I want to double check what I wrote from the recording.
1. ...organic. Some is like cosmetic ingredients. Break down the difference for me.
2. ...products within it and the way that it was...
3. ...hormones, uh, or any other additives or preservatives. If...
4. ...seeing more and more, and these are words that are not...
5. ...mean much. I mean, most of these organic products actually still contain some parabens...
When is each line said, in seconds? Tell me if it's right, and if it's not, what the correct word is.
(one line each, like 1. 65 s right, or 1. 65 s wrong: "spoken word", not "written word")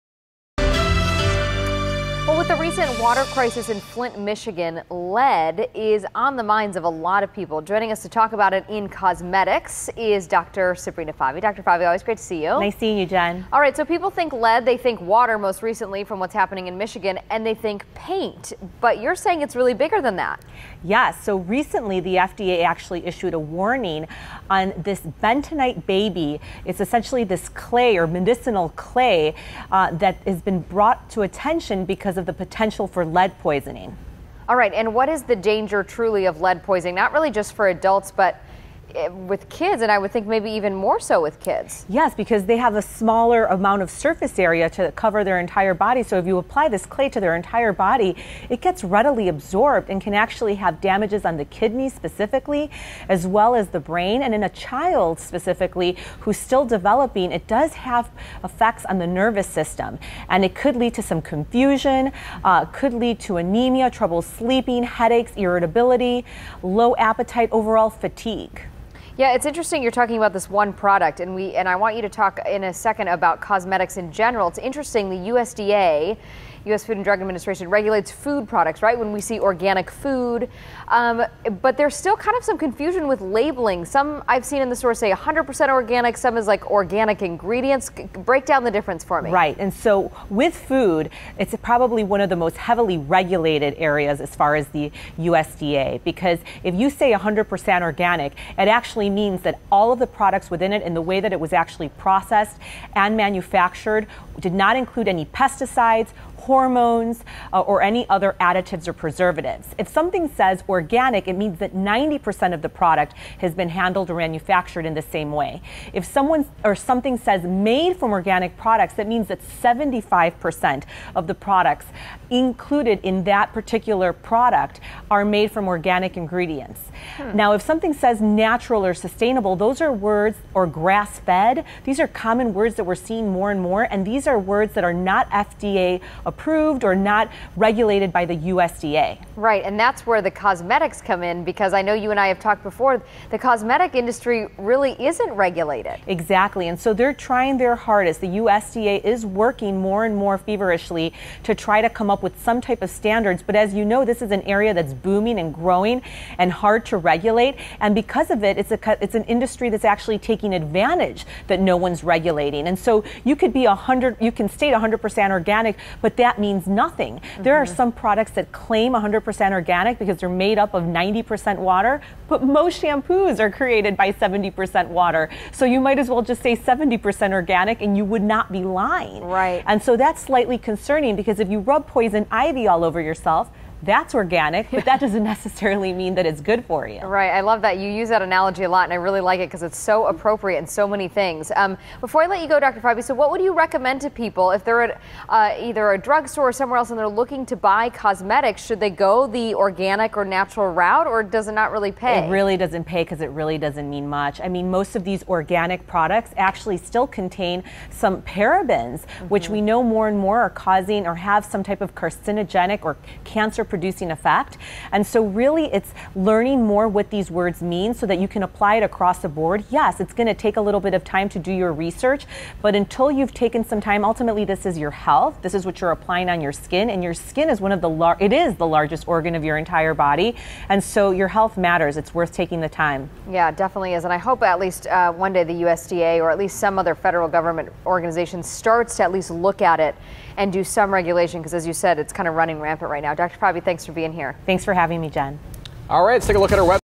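1. 85 s wrong: "organic", not "cosmetic"
2. 100 s right
3. 106 s right
4. 132 s right
5. 203 s right.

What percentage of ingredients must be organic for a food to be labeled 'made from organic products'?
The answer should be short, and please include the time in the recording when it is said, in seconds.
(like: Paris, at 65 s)
75%, at 119 s.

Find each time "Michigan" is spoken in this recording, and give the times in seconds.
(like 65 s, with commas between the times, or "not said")
4 s, 16 s.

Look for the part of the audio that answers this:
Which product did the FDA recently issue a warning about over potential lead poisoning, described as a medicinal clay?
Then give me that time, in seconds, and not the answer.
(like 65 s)
25 s.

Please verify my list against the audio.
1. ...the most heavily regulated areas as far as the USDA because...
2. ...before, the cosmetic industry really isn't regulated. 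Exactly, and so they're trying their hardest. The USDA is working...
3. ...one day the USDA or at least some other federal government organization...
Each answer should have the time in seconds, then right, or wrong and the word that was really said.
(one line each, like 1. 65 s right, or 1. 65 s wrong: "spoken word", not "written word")
1. 92 s right
2. 142 s right
3. 235 s right.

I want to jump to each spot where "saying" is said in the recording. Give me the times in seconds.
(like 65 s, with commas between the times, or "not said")
19 s.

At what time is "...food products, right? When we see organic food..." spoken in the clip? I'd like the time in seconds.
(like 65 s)
78 s.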